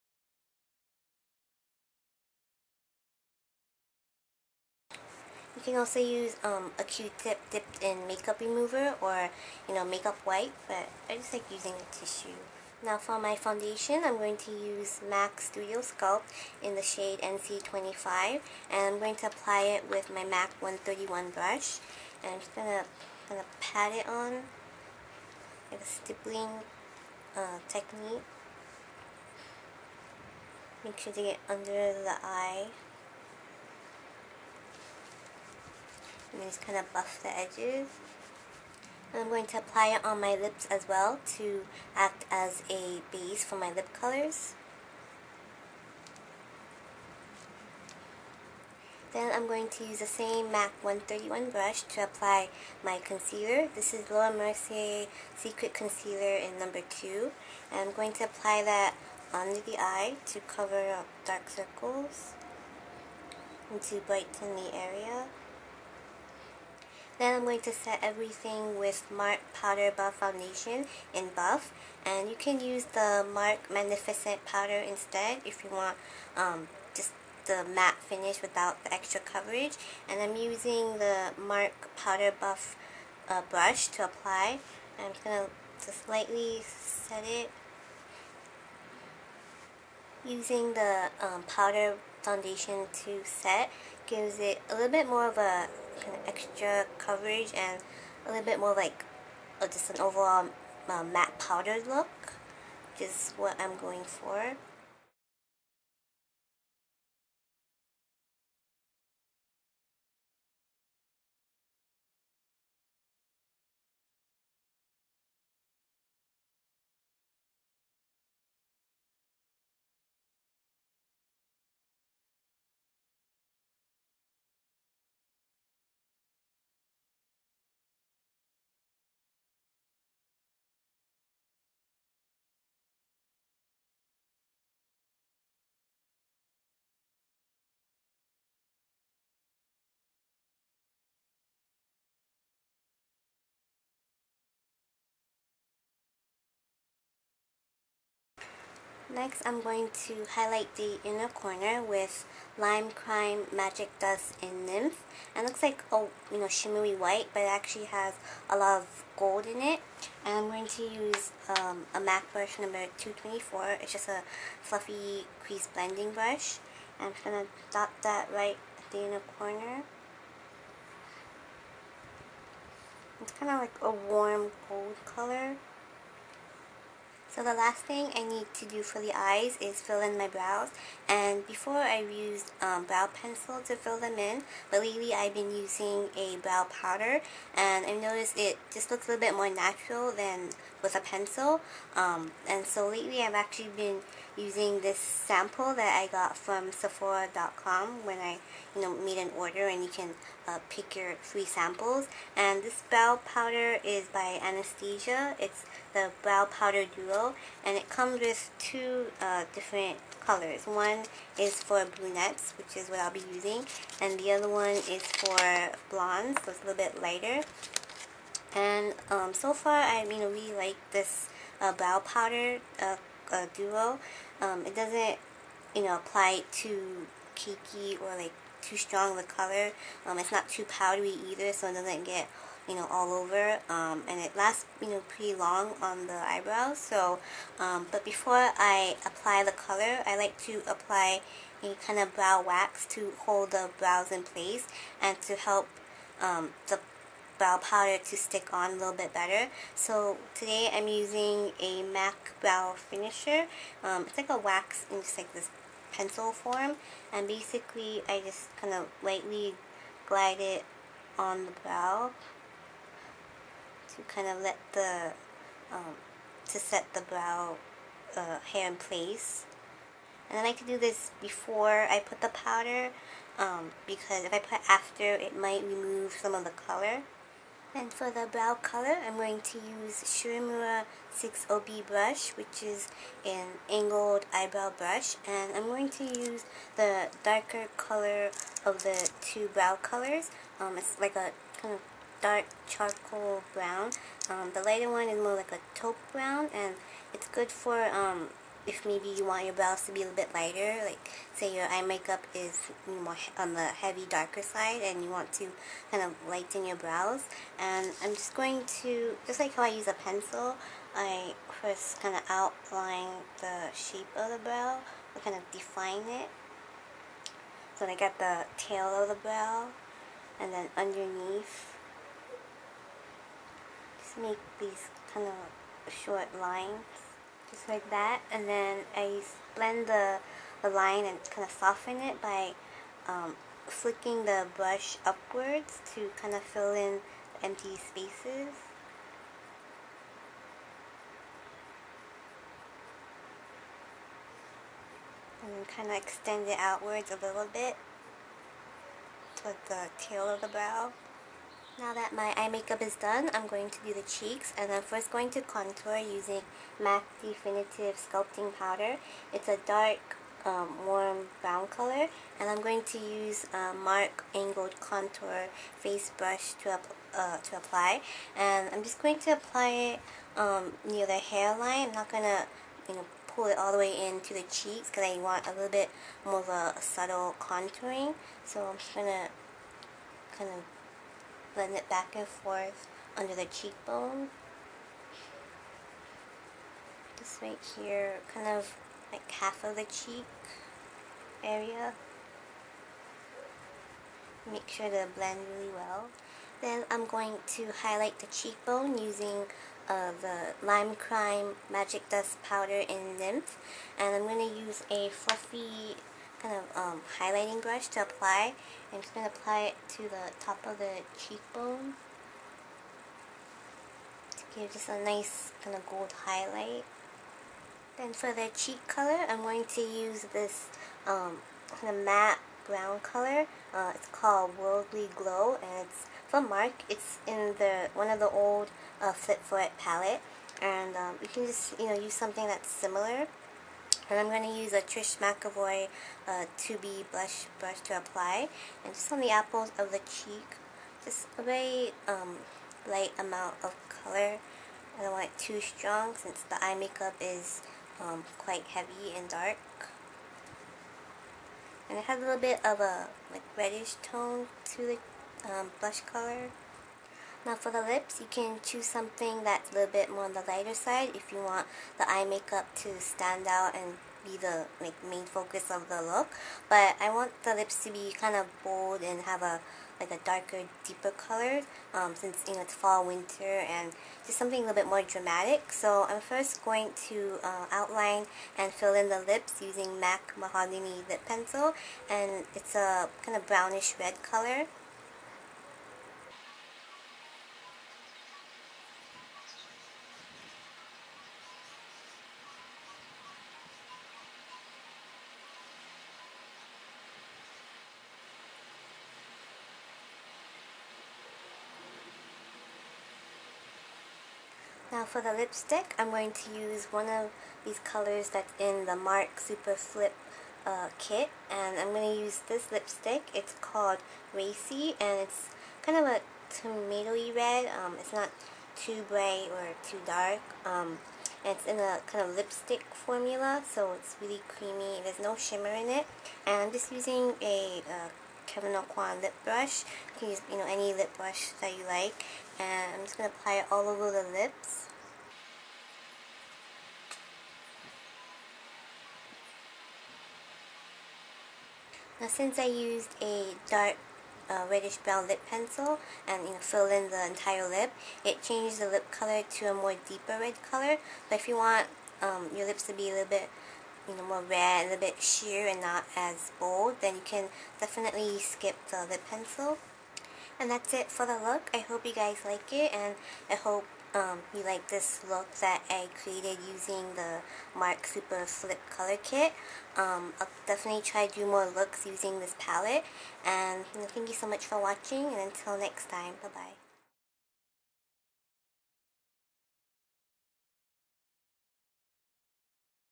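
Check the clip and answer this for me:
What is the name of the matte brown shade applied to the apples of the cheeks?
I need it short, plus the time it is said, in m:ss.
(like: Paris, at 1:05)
Worldly Glow, at 7:04.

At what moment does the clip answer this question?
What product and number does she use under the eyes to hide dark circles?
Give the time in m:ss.
0:56.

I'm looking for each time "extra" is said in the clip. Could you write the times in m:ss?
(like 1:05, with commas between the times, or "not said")
1:18, 1:36.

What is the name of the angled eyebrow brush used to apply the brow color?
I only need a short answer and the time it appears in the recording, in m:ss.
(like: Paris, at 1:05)
Shu Uemura 6OB, at 4:40.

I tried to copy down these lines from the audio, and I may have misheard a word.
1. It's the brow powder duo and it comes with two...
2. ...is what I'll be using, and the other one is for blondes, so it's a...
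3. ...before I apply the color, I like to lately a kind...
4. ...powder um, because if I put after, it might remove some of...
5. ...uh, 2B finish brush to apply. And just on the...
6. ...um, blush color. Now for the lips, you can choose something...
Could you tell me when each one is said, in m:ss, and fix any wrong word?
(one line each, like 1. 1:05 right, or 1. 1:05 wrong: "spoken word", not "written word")
1. 3:25 right
2. 3:32 right
3. 3:58 wrong: "apply", not "lately"
4. 4:32 right
5. 7:16 wrong: "blush", not "finish"
6. 7:35 right.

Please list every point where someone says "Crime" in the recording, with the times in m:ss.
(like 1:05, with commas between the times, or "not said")
2:32, 6:40.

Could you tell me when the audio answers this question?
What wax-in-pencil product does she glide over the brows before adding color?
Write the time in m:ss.
4:11.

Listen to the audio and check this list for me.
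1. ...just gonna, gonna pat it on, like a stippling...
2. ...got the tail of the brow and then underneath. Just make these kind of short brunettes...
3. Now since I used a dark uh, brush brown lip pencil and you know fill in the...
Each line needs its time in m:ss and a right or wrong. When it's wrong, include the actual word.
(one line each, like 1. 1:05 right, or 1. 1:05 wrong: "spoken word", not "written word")
1. 0:22 right
2. 5:17 wrong: "lines", not "brunettes"
3. 9:02 wrong: "reddish", not "brush".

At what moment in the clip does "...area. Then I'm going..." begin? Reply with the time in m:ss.
1:04.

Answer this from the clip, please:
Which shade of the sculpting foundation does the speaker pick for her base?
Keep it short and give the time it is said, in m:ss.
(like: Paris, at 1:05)
NC25, at 0:17.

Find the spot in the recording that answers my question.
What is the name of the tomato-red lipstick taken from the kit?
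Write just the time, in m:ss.
8:34.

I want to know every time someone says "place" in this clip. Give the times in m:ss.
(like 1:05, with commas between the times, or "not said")
4:04, 4:28.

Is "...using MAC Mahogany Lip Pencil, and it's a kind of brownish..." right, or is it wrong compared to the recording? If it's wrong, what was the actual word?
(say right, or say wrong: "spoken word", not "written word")
right.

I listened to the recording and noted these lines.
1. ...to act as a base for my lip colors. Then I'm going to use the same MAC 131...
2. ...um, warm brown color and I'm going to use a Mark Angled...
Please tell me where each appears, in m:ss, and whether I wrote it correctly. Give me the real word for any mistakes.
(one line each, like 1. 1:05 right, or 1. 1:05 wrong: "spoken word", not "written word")
1. 0:41 right
2. 6:00 right.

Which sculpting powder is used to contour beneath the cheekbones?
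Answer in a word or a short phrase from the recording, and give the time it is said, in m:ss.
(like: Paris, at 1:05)
MAC Definitive Sculpting Powder, at 5:56.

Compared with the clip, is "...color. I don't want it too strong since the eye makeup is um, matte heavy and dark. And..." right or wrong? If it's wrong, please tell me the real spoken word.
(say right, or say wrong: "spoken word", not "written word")
wrong: "quite", not "matte".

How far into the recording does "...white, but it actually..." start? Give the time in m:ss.
2:36.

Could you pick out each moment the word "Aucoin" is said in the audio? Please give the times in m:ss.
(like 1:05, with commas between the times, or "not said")
8:48.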